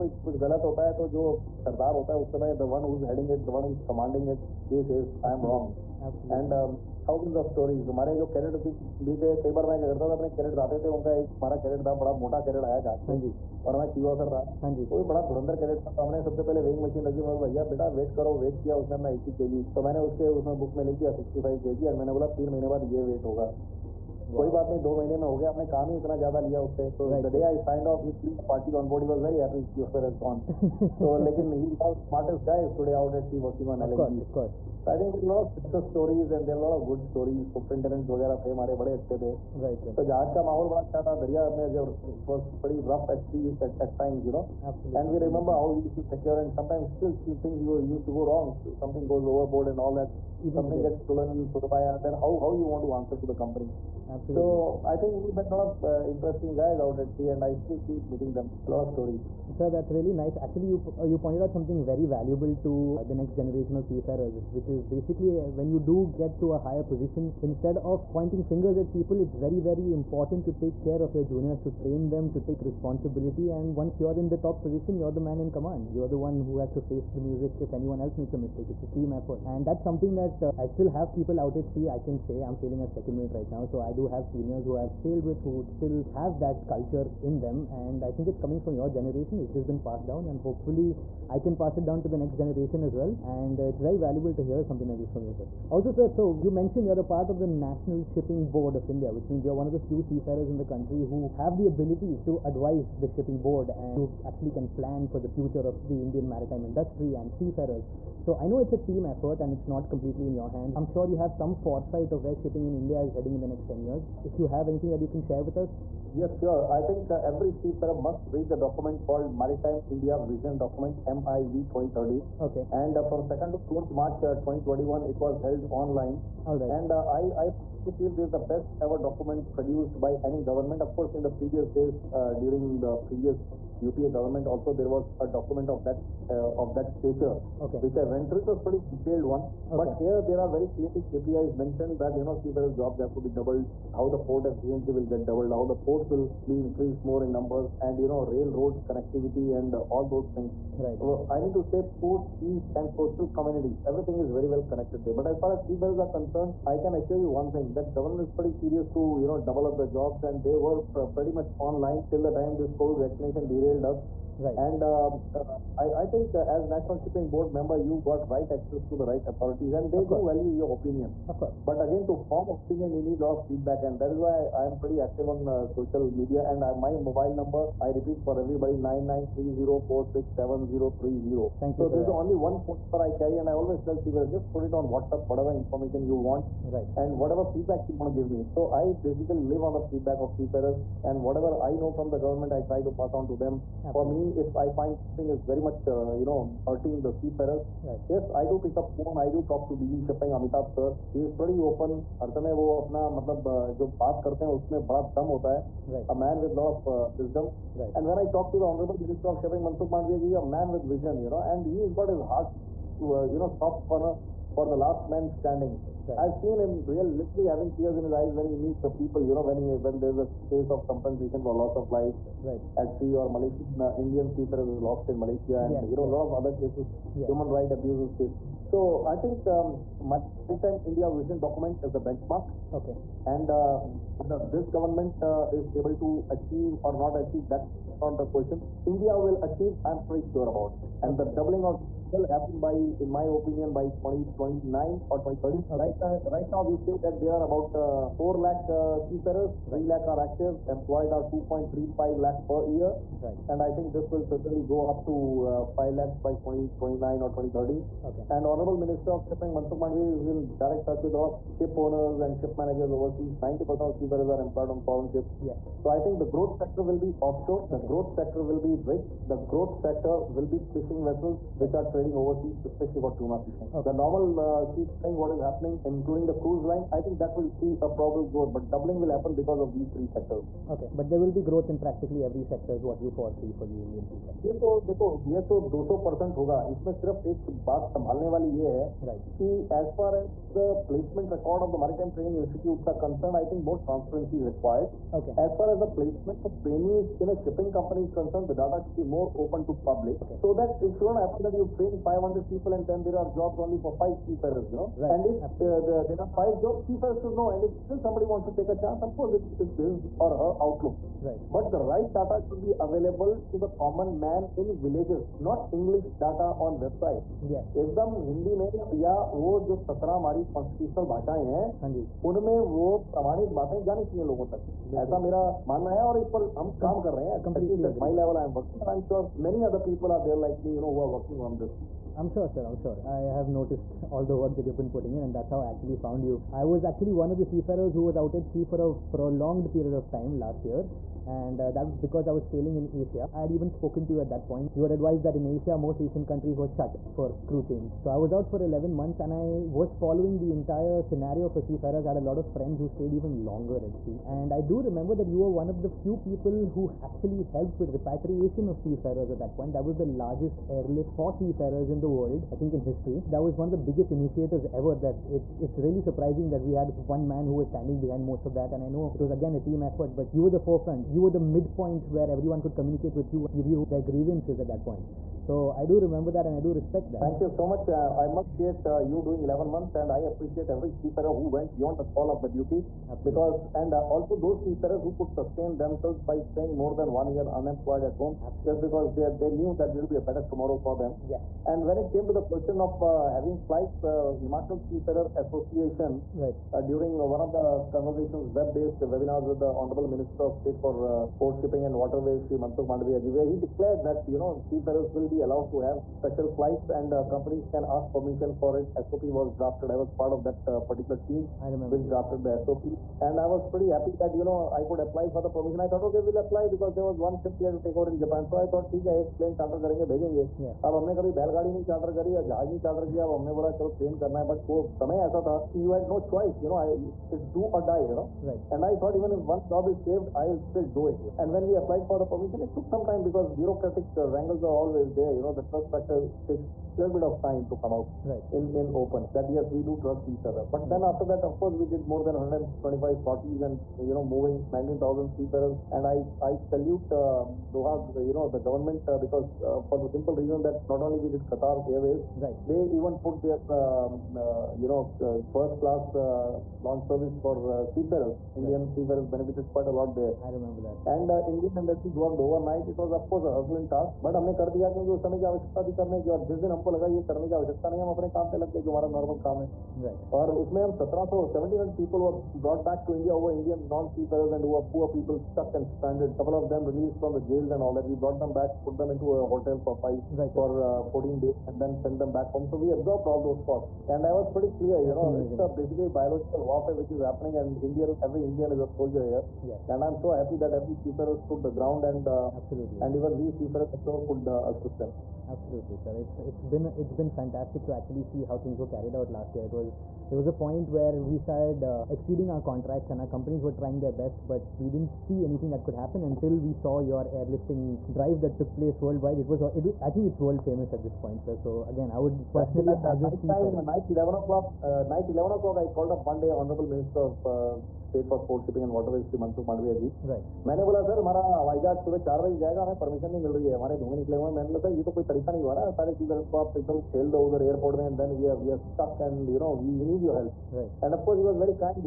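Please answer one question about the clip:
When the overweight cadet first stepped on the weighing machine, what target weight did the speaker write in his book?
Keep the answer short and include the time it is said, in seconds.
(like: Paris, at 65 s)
65 kg, at 21 s.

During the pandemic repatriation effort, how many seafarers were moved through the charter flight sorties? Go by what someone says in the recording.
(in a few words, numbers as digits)
19000.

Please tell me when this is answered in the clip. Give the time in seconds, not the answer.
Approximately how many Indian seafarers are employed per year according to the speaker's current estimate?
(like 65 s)
251 s.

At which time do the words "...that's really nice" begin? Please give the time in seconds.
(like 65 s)
59 s.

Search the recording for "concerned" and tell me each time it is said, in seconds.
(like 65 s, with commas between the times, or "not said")
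156 s, 293 s, 298 s.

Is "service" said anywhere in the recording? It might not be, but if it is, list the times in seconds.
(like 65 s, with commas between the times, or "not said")
457 s.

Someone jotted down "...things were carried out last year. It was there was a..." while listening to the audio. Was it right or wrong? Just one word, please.
right.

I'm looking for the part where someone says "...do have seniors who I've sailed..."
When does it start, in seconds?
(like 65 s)
83 s.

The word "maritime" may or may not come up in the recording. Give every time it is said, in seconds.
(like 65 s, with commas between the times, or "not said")
106 s, 119 s, 230 s, 291 s.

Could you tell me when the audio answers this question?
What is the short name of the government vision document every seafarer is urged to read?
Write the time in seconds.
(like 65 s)
121 s.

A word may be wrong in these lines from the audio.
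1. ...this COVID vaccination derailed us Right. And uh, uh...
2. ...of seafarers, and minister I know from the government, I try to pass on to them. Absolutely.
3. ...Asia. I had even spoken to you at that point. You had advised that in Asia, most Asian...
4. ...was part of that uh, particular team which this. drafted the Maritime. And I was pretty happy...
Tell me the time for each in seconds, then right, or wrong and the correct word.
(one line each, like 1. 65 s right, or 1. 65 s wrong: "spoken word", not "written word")
1. 162 s right
2. 190 s wrong: "whatever", not "minister"
3. 343 s right
4. 409 s wrong: "SOP", not "Maritime".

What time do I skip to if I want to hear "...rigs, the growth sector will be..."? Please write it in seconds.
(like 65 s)
268 s.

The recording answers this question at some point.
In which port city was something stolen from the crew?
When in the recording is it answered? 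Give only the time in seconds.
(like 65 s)
51 s.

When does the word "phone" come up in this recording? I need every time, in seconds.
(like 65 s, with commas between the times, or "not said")
182 s, 198 s.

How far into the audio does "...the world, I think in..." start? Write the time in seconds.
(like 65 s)
362 s.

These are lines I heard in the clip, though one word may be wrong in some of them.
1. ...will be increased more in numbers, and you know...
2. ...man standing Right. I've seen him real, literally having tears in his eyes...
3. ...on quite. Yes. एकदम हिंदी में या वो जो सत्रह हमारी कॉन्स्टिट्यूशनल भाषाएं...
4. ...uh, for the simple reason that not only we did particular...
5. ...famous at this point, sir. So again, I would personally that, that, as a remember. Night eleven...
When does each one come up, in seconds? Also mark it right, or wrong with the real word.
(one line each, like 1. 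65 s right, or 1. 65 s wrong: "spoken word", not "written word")
1. 146 s right
2. 215 s right
3. 316 s wrong: "website", not "quite"
4. 449 s wrong: "qatar", not "particular"
5. 510 s wrong: "seafarer", not "remember".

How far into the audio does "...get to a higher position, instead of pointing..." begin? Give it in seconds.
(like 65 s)
66 s.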